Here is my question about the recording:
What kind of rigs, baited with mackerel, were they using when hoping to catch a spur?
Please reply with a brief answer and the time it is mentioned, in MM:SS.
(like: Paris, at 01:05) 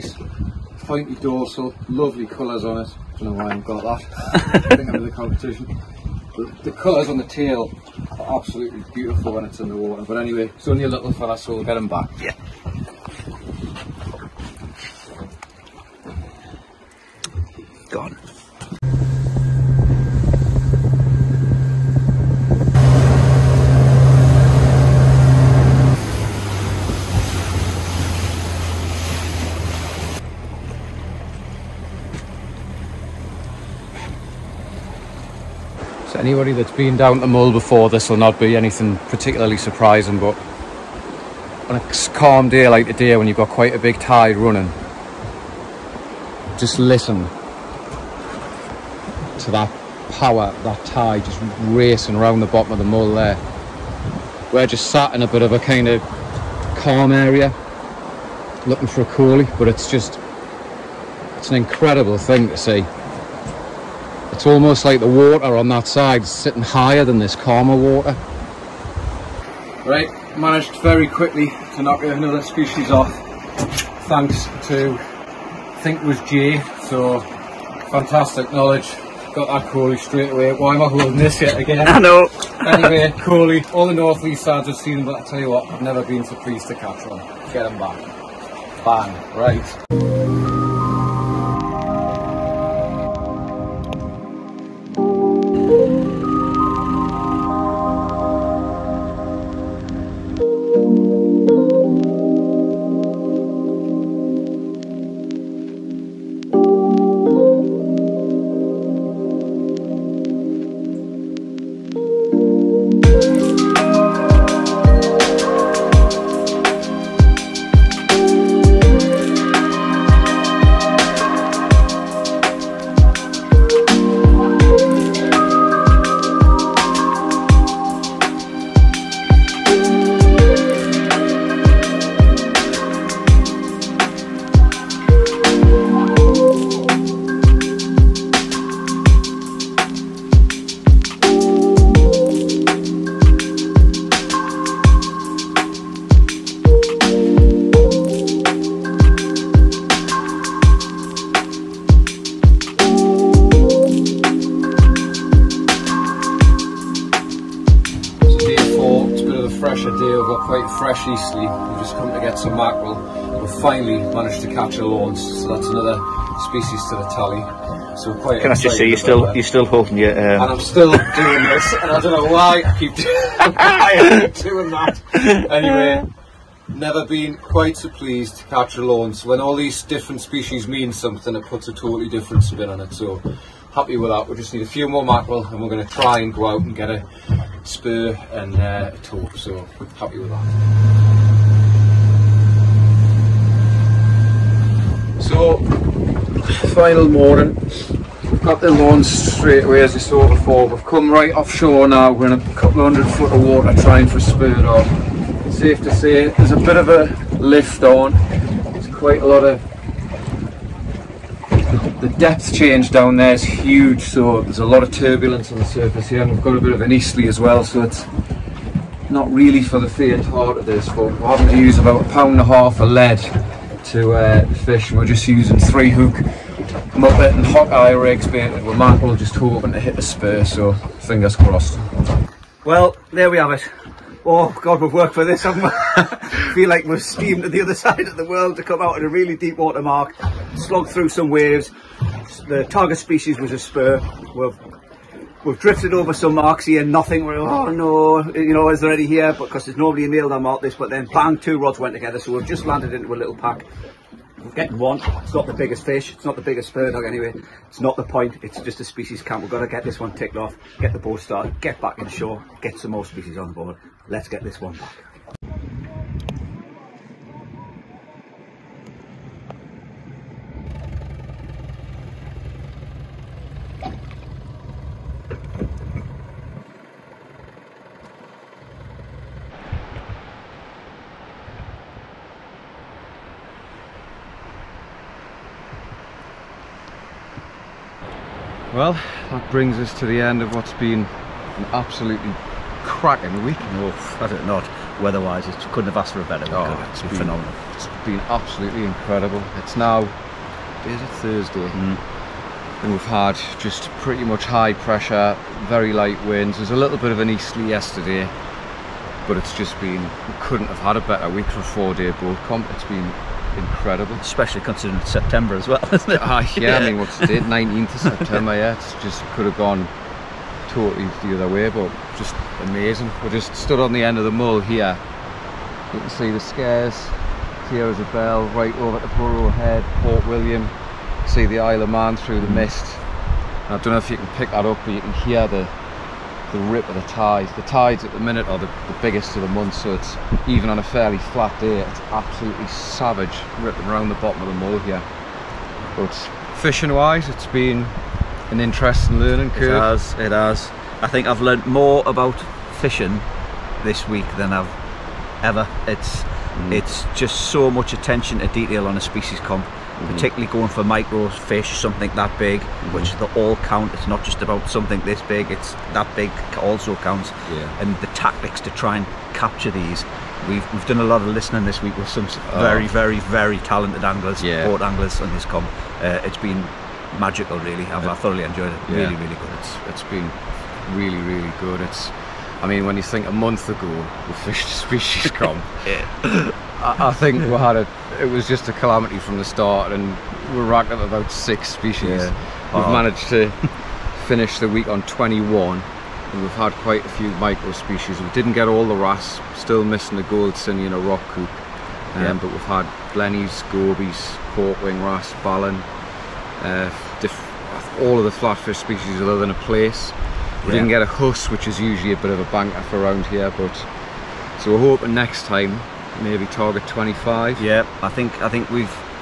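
three hook muppet, at 03:45.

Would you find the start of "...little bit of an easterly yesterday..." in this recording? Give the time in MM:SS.
05:06.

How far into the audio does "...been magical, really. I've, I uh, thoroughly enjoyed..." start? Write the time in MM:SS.
06:16.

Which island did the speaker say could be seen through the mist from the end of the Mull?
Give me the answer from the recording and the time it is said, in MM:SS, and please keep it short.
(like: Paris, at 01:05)
Isle of Man, at 05:31.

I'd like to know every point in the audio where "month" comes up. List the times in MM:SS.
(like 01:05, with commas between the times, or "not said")
05:39, 06:23.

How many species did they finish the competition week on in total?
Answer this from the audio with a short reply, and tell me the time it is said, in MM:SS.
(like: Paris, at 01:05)
21, at 06:35.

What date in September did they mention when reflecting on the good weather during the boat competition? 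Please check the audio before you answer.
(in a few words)
19th.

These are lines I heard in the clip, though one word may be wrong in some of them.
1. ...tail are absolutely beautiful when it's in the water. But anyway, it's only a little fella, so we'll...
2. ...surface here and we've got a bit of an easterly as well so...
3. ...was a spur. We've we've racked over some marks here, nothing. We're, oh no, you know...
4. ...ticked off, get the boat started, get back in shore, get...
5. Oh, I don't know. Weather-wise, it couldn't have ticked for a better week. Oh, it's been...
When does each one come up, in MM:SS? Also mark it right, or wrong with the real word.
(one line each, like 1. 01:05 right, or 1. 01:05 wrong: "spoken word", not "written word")
1. 00:07 right
2. 03:35 right
3. 04:03 wrong: "drifted", not "racked"
4. 04:20 right
5. 04:53 wrong: "asked", not "ticked".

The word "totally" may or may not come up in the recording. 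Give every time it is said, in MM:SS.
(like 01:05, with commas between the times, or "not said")
03:01, 05:20.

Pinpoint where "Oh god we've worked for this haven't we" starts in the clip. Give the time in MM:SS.
03:54.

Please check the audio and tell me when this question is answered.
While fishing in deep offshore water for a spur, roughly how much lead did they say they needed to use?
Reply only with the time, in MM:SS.
03:42.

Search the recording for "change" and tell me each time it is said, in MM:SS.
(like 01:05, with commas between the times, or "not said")
03:32.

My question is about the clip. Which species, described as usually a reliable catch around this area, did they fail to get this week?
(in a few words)
huss.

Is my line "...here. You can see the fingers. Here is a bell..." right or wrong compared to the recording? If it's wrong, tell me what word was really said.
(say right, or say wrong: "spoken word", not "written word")
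wrong: "stairs", not "fingers".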